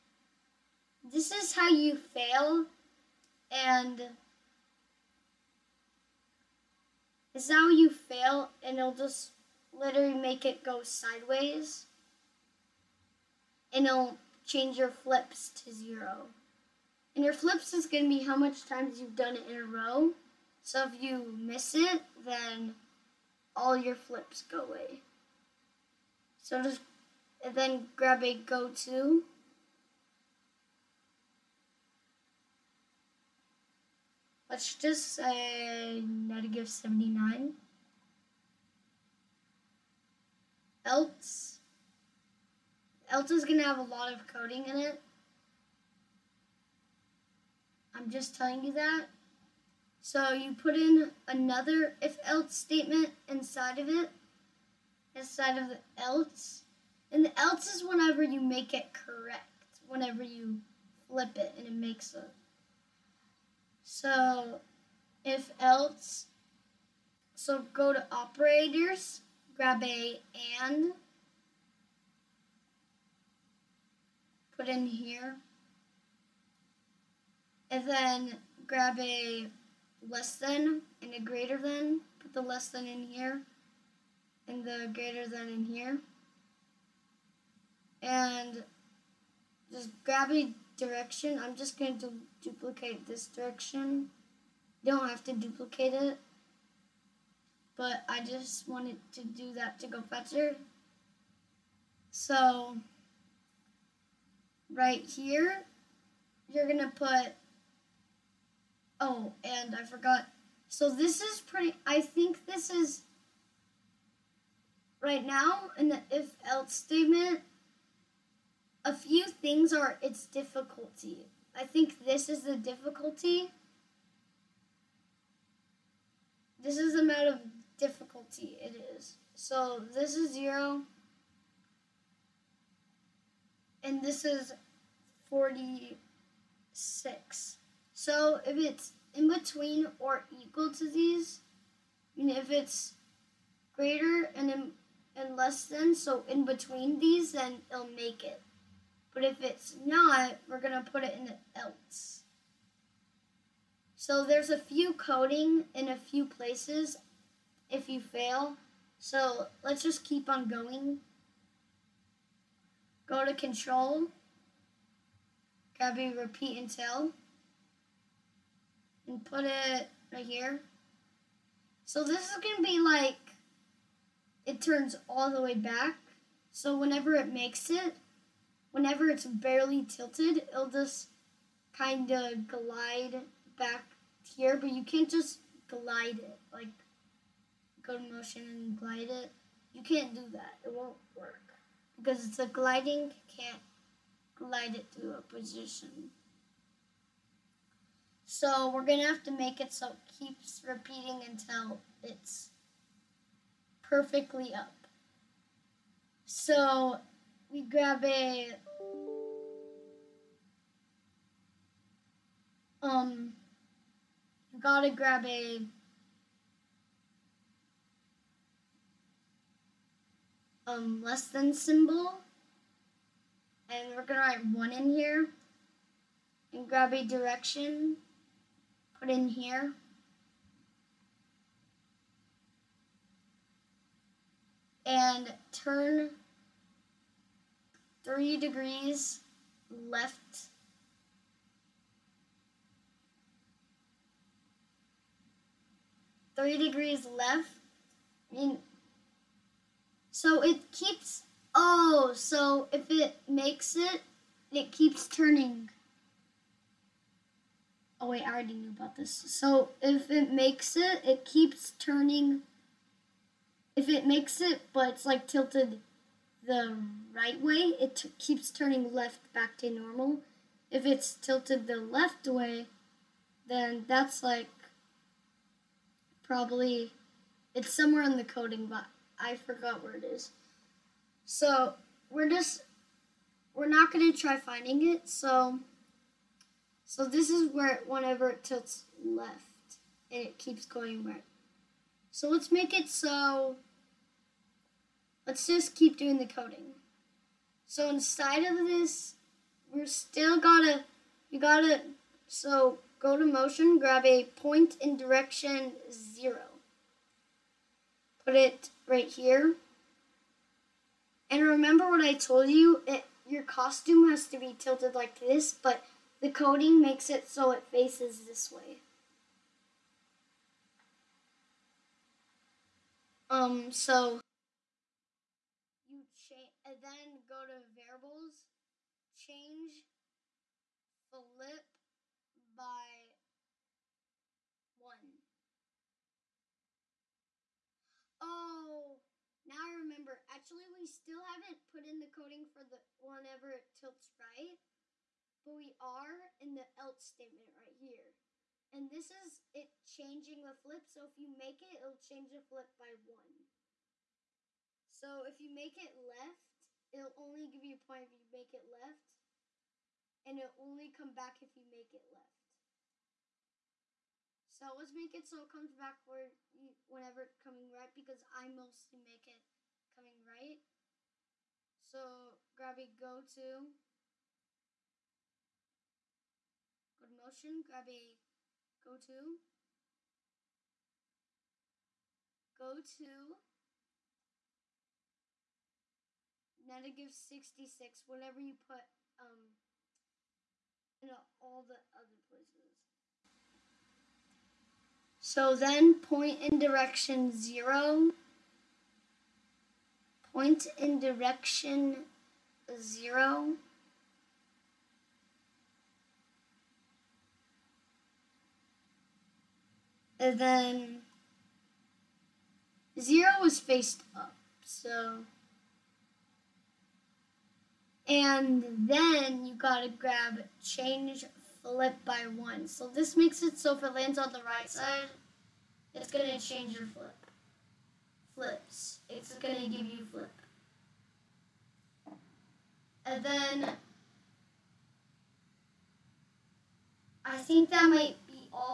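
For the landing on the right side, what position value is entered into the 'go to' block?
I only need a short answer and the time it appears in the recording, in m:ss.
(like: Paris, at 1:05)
-66, at 6:26.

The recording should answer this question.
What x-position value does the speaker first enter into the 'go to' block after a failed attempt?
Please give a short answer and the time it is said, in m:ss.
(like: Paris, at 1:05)
-79, at 0:36.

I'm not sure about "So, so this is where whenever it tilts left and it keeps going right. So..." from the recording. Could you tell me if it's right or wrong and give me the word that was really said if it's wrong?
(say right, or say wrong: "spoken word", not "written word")
right.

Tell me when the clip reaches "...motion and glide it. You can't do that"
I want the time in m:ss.
3:08.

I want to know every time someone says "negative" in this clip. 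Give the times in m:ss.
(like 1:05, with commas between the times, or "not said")
0:36, 6:26.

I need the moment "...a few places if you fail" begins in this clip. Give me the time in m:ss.
2:35.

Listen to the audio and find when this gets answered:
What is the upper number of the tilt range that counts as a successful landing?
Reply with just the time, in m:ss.
2:15.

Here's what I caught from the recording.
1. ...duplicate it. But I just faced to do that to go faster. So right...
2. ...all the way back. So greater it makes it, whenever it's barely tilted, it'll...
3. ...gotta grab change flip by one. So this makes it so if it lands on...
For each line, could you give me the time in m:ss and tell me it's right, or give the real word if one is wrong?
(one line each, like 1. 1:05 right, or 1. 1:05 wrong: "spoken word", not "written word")
1. 1:35 wrong: "wanted", not "faced"
2. 2:55 wrong: "whenever", not "greater"
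3. 6:59 right.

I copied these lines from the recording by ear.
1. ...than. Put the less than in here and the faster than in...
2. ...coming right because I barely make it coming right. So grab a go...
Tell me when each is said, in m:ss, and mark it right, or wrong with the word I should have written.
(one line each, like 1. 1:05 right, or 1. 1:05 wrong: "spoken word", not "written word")
1. 1:21 wrong: "greater", not "faster"
2. 6:07 wrong: "mostly", not "barely".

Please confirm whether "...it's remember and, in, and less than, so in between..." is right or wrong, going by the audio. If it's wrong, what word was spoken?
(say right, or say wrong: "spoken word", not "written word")
wrong: "greater", not "remember".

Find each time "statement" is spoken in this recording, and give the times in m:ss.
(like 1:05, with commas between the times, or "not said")
0:52, 1:56, 5:47.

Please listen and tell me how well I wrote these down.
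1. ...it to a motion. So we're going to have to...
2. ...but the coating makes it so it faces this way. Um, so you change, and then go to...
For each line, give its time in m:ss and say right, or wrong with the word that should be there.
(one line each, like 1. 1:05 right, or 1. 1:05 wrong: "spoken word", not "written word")
1. 3:14 wrong: "position", not "motion"
2. 5:15 right.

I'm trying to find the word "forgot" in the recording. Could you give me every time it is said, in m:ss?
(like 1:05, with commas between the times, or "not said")
1:49, 4:39.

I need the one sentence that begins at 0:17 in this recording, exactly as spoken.
And your flips is going to be how much times you've done it in a row.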